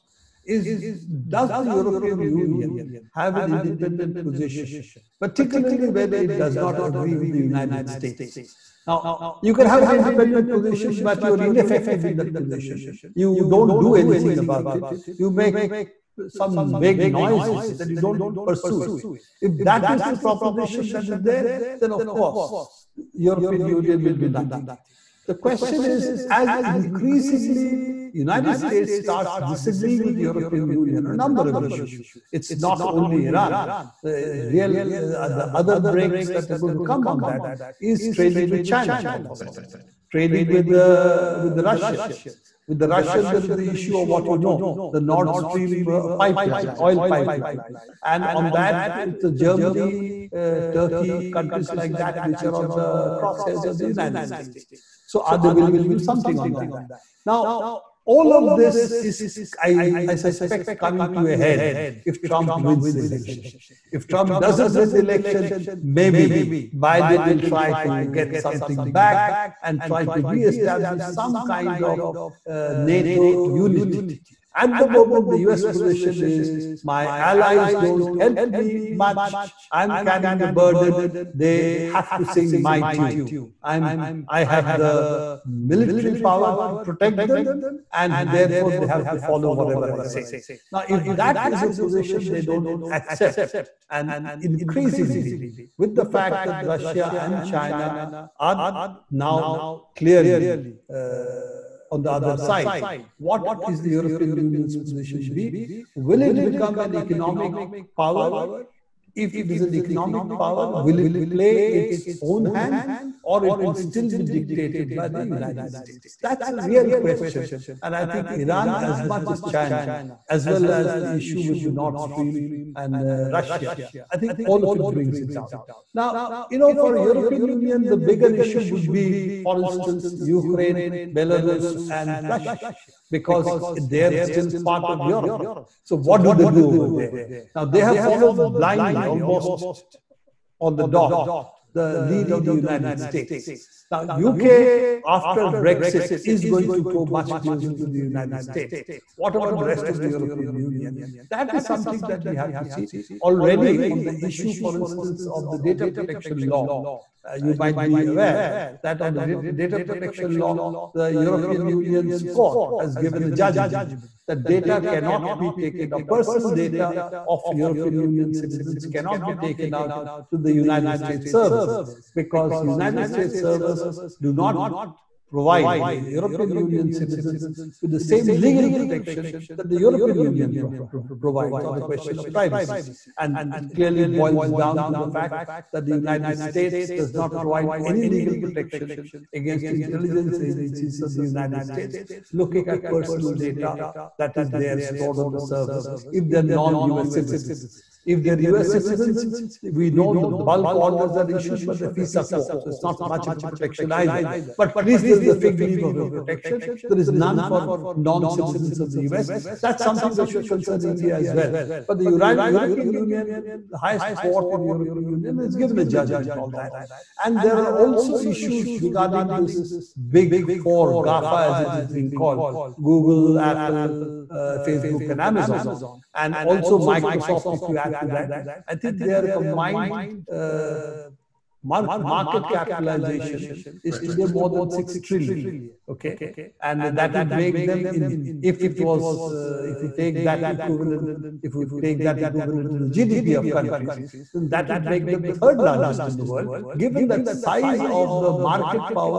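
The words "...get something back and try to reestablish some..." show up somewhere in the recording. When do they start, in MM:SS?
01:08.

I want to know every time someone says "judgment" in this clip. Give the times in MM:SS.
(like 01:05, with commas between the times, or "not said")
02:43, 03:35.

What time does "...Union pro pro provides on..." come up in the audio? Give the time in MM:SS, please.
03:00.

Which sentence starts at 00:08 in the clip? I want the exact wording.
Now, you can have an independent position, but you're ineffective in that position.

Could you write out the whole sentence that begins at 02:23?
Now, UK, after Brexit, is going to go much closer to the United States.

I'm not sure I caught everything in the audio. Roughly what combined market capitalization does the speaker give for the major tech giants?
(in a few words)
more than 6 trillion.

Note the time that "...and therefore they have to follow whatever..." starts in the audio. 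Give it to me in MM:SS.
01:27.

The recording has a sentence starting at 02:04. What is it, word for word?
I think all of it brings it down.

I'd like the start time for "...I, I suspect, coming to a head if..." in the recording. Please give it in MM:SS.
00:59.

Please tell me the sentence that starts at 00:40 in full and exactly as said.
trading with the with the Russians.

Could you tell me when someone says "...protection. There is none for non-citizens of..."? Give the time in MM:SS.
03:26.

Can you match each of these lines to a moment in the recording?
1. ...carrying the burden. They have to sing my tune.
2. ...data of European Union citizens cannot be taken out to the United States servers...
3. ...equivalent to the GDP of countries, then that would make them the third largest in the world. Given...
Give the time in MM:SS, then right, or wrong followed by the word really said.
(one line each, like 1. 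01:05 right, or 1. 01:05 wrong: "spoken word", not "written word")
1. 01:19 right
2. 02:46 right
3. 04:02 right.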